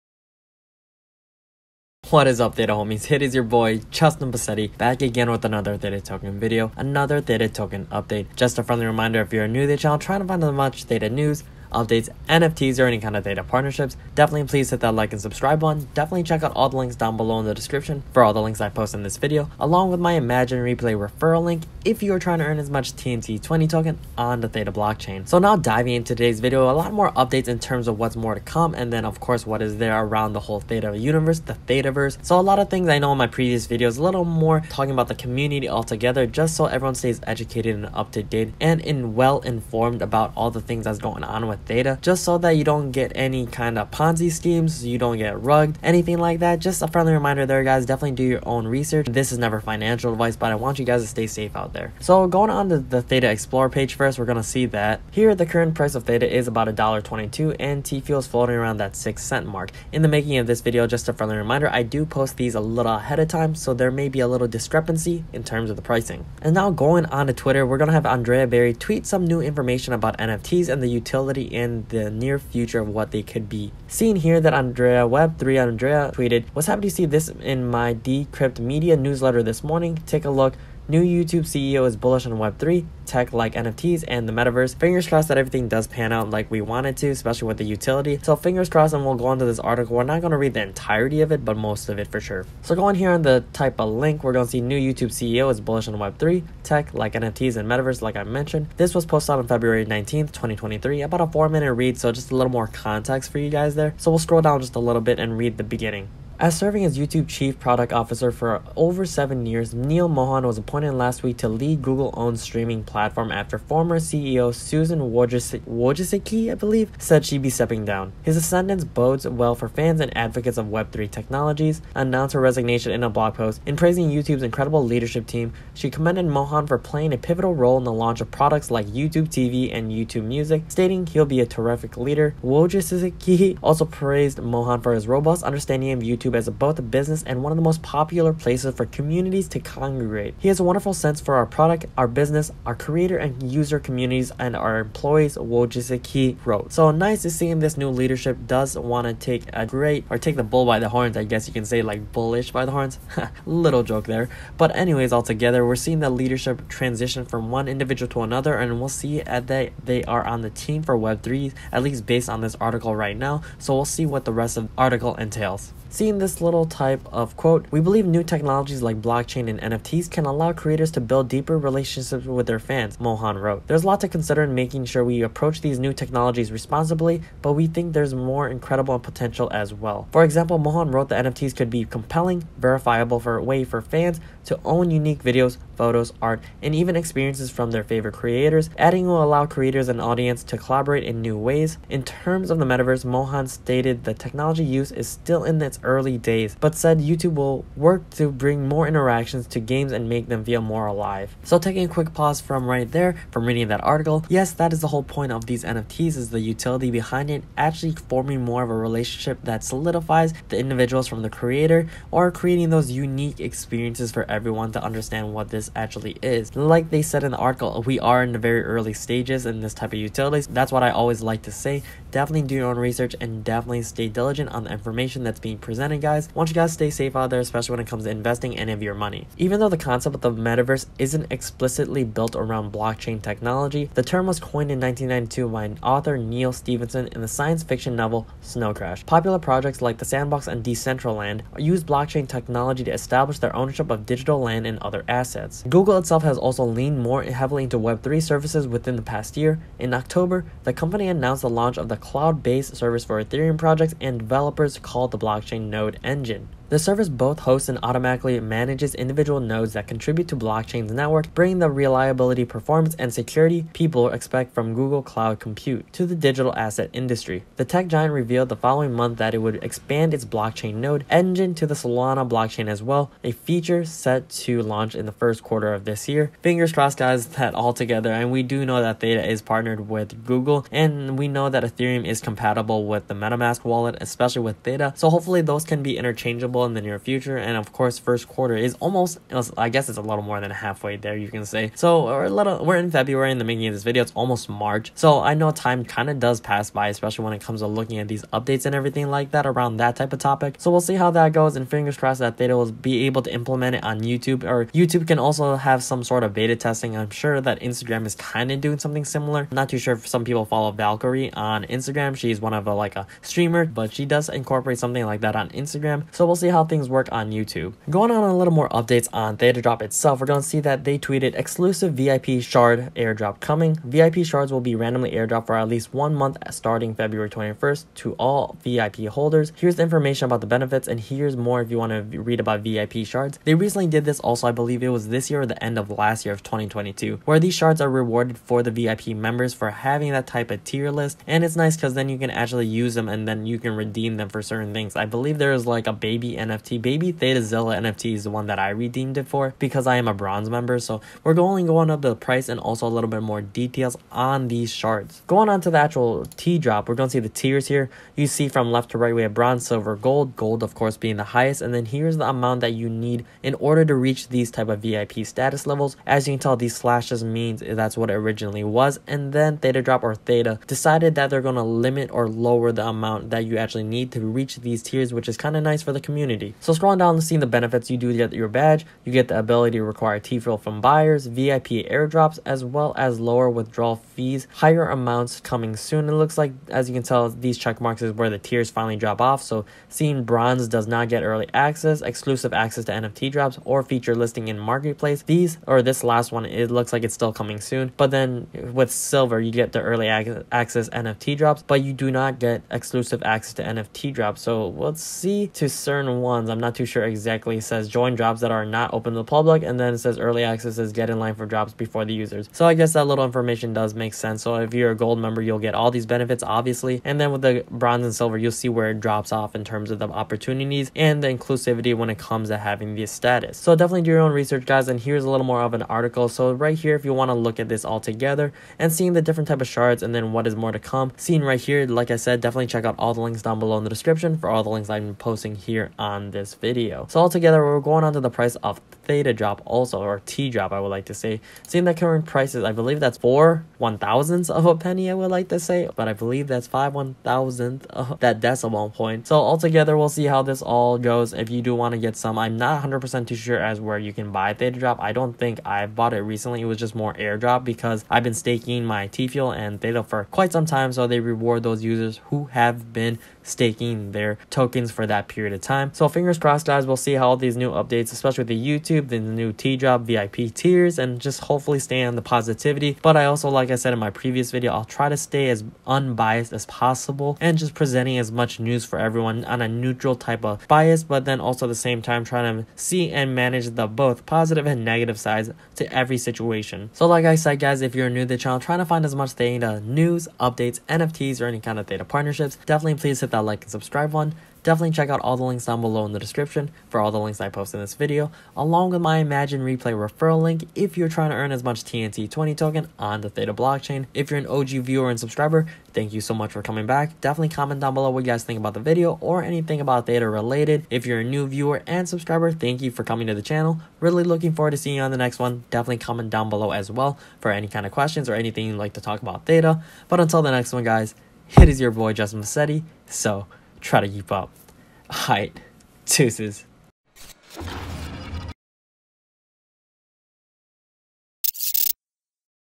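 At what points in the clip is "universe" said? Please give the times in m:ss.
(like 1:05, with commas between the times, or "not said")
0:30.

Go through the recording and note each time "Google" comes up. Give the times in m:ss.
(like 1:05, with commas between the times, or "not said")
1:51, 4:05, 4:24, 4:40.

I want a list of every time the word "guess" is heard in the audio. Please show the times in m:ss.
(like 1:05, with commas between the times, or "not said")
2:31, 4:49, 6:52.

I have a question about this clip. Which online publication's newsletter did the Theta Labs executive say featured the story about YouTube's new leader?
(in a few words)
Decrypt Media.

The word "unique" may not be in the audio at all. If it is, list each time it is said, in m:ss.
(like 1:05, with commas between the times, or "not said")
3:04, 3:32.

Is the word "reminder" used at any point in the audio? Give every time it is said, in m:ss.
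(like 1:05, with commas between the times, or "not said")
0:08, 0:47, 1:01.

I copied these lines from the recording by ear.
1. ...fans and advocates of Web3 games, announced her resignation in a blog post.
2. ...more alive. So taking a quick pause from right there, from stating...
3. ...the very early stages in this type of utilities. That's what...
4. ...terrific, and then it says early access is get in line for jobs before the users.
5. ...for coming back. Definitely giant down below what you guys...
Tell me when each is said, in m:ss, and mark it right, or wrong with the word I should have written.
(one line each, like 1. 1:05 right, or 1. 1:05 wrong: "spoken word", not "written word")
1. 1:59 wrong: "technologies", not "games"
2. 3:20 wrong: "reading", not "stating"
3. 3:38 right
4. 6:49 wrong: "public", not "terrific"
5. 8:26 wrong: "comment", not "giant".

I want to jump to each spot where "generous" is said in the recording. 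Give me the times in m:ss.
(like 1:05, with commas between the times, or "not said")
not said.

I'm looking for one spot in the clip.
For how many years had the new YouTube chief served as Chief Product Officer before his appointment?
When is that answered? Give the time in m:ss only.
1:49.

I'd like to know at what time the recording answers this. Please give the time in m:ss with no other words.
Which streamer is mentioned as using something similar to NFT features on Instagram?
5:10.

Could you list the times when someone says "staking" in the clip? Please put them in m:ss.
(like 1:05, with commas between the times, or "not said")
7:38, 7:43.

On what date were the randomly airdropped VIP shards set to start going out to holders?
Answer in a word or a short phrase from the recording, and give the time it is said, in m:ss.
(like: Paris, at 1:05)
February 21st, at 5:26.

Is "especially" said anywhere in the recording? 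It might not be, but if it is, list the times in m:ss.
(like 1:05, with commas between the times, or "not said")
1:27, 3:47, 4:43, 4:56, 7:48.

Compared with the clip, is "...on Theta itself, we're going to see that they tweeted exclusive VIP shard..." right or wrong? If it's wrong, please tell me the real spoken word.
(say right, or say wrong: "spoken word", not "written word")
right.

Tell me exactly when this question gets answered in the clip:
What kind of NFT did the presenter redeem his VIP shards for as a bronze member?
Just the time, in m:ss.
5:46.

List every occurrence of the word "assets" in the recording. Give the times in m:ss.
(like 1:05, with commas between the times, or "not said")
4:05, 4:26.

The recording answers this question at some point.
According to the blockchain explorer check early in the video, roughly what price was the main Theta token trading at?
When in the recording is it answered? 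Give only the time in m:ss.
0:56.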